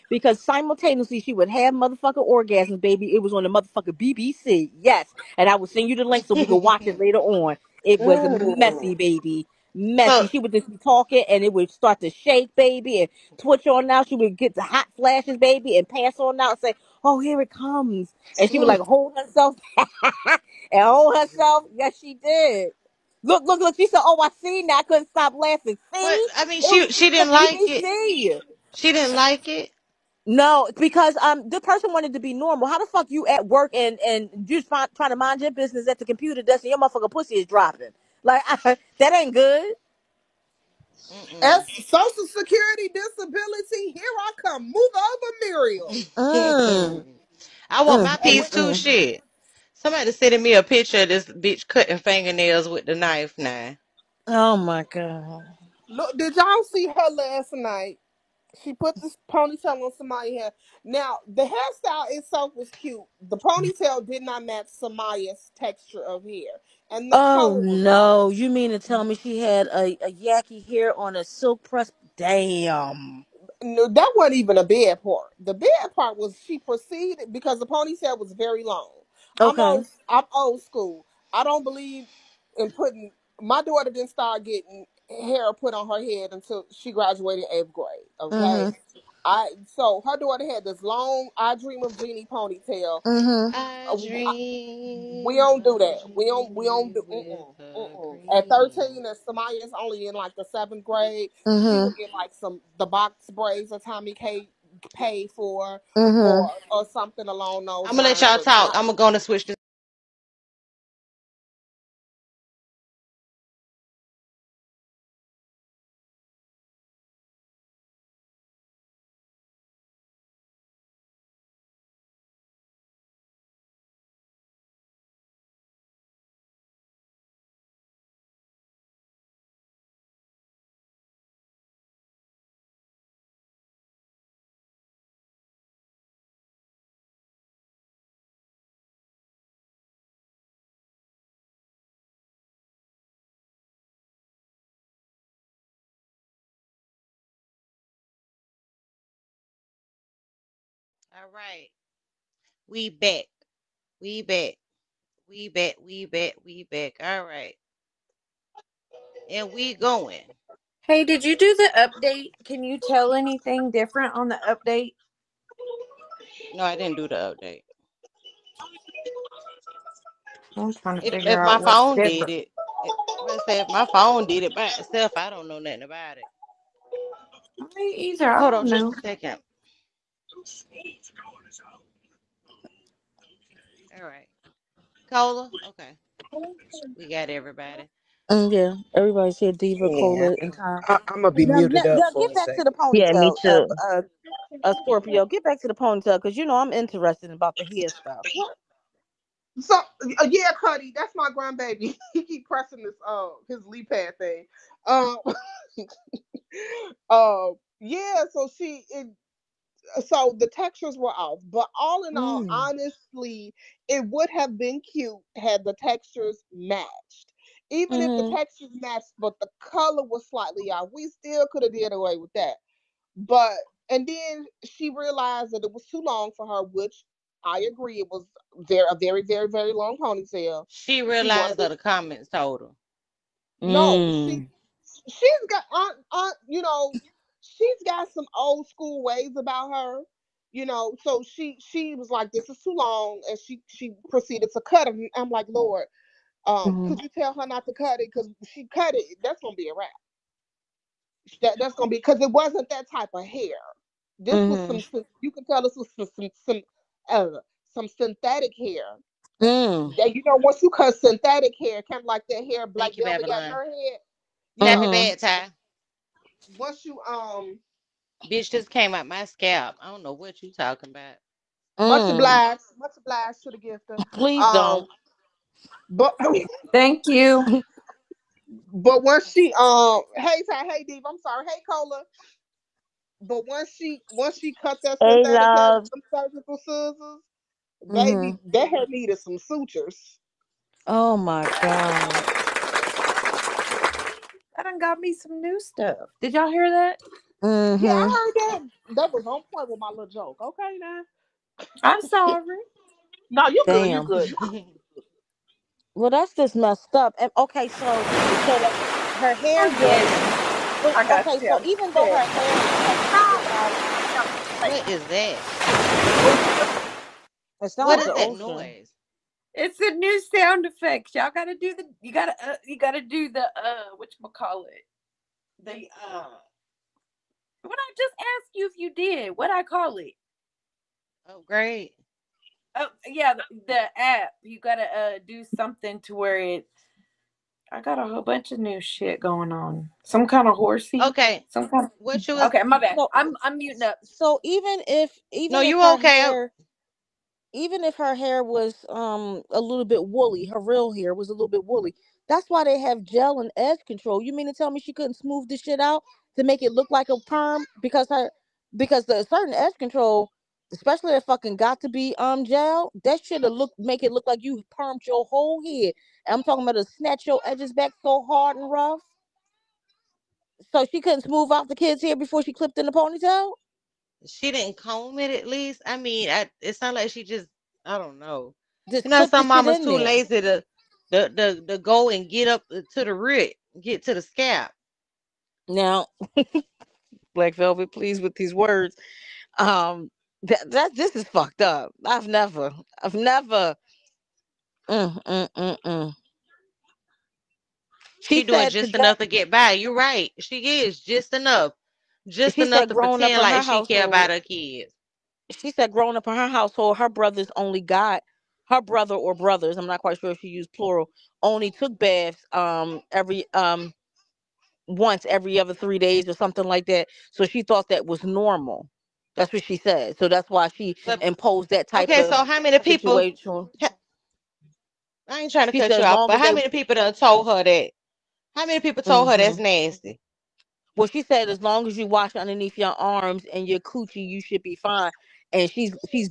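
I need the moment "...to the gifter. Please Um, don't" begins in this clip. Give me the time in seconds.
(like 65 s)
273 s.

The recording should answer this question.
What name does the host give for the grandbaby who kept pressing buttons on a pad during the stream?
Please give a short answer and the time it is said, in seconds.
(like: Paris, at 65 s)
Cuddy, at 200 s.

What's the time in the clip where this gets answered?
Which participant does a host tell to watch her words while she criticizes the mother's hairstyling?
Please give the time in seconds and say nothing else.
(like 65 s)
387 s.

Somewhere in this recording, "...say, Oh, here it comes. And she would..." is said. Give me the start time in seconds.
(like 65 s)
16 s.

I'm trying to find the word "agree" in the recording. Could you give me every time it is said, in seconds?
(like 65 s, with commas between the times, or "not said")
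227 s.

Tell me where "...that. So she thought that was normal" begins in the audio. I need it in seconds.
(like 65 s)
416 s.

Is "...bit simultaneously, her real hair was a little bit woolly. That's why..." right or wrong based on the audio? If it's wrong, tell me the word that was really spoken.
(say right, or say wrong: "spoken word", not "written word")
wrong: "woolly", not "simultaneously".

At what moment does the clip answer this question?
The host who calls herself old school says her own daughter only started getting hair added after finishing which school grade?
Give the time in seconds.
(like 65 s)
87 s.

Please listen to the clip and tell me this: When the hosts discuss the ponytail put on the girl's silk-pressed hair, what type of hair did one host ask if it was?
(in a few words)
yaki hair.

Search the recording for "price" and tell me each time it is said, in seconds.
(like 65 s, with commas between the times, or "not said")
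not said.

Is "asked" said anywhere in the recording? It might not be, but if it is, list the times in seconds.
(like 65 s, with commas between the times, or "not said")
328 s.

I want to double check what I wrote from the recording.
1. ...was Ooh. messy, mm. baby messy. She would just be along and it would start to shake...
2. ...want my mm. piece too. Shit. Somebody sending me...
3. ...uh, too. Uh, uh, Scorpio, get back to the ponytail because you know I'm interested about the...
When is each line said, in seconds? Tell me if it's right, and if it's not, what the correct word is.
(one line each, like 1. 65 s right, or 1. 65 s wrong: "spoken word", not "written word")
1. 7 s wrong: "talking", not "along"
2. 47 s right
3. 193 s right.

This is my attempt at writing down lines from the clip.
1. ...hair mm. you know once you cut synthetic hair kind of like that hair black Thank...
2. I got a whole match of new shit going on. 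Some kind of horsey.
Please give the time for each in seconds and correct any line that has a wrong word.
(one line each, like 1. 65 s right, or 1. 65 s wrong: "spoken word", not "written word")
1. 258 s right
2. 337 s wrong: "bunch", not "match".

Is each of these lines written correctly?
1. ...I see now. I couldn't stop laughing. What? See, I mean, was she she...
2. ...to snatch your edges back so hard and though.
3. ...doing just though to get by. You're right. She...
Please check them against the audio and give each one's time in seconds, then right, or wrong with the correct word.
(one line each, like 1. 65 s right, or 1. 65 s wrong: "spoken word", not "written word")
1. 24 s right
2. 366 s wrong: "rough", not "though"
3. 398 s wrong: "enough", not "though".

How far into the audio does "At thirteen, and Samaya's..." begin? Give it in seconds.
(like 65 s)
98 s.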